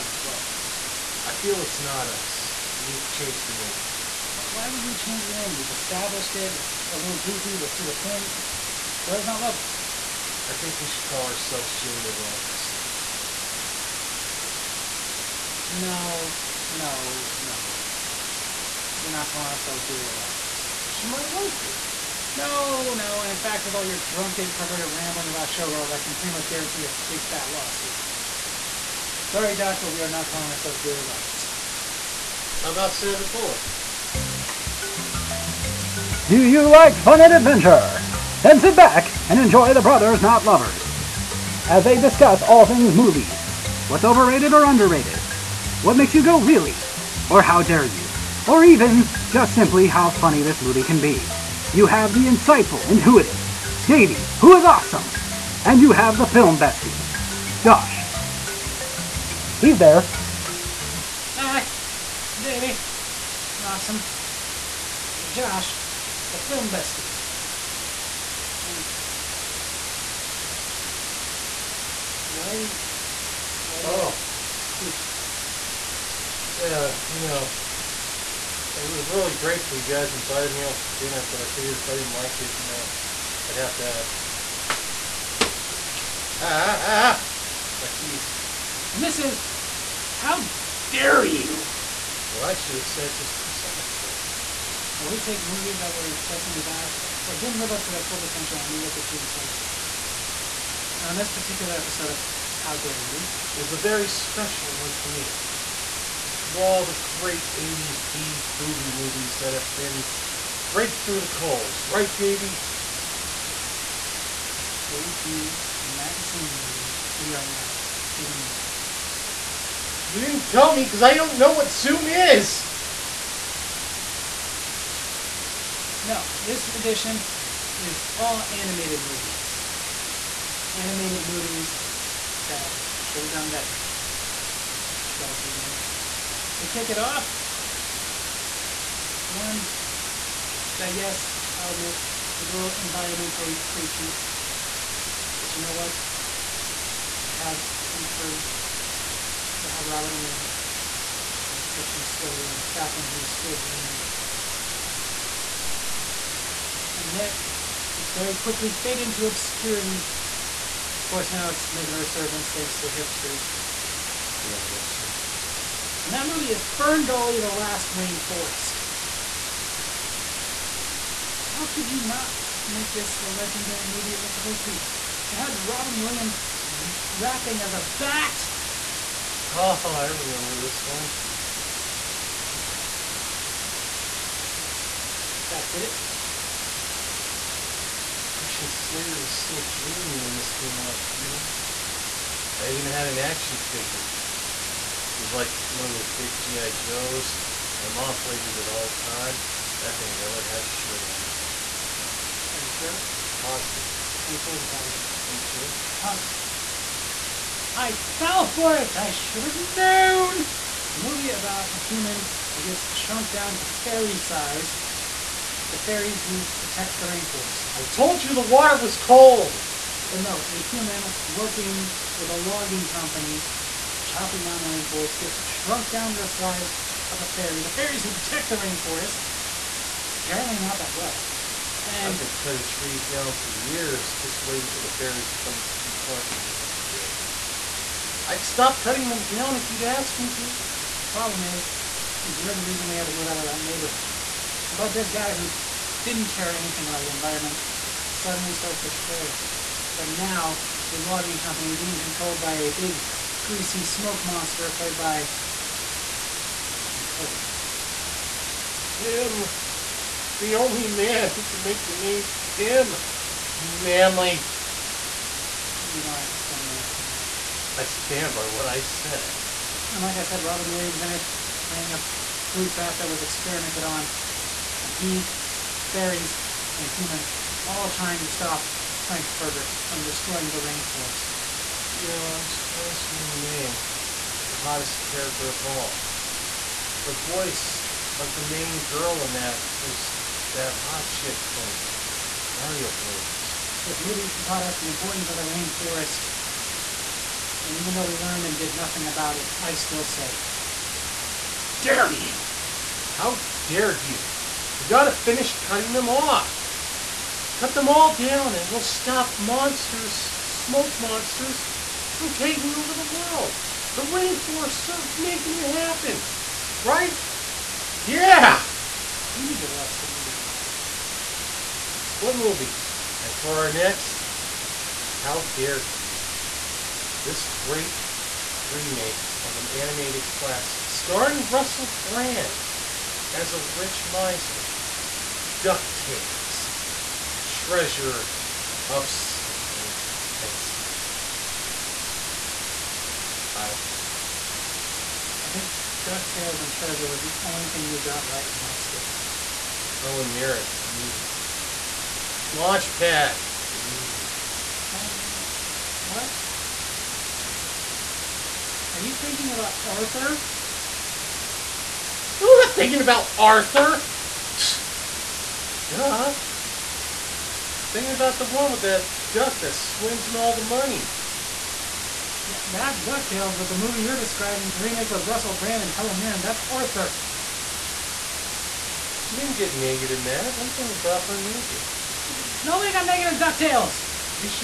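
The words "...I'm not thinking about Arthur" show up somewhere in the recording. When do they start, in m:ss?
6:02.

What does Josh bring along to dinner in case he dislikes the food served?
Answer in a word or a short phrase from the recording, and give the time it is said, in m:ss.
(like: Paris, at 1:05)
Soup, at 1:14.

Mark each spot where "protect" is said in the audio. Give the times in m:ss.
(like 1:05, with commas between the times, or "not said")
3:36, 3:48.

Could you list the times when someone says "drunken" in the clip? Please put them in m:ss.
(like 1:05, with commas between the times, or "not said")
0:23.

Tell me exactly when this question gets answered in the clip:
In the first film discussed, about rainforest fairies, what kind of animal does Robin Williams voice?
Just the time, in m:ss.
4:32.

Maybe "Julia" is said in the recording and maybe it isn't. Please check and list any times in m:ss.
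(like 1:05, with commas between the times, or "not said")
0:11, 0:19, 0:30.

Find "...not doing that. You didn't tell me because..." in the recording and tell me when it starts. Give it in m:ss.
1:57.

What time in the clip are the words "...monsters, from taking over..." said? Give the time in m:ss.
5:10.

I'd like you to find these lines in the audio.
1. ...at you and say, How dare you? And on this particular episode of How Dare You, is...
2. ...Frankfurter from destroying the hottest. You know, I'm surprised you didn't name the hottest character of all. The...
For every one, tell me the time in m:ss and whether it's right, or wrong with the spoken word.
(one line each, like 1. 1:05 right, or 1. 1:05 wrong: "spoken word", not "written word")
1. 1:38 right
2. 4:39 wrong: "rainforest", not "hottest".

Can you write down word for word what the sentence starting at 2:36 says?
And yet, it very quickly faded into obscurity.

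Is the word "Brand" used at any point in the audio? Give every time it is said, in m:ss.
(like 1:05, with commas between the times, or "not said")
5:32, 6:15.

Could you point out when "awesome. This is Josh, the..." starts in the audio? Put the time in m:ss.
1:03.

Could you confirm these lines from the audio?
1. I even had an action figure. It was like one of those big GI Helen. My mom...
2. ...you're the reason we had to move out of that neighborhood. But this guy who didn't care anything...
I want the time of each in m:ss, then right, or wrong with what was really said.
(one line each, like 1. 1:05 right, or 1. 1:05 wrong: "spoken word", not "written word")
1. 3:12 wrong: "Joes", not "Helen"
2. 4:02 right.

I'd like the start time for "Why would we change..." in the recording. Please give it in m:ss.
0:04.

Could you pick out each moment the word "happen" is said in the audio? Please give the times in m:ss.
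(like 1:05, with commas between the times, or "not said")
5:15.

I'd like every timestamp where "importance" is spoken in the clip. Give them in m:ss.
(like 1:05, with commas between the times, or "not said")
4:54.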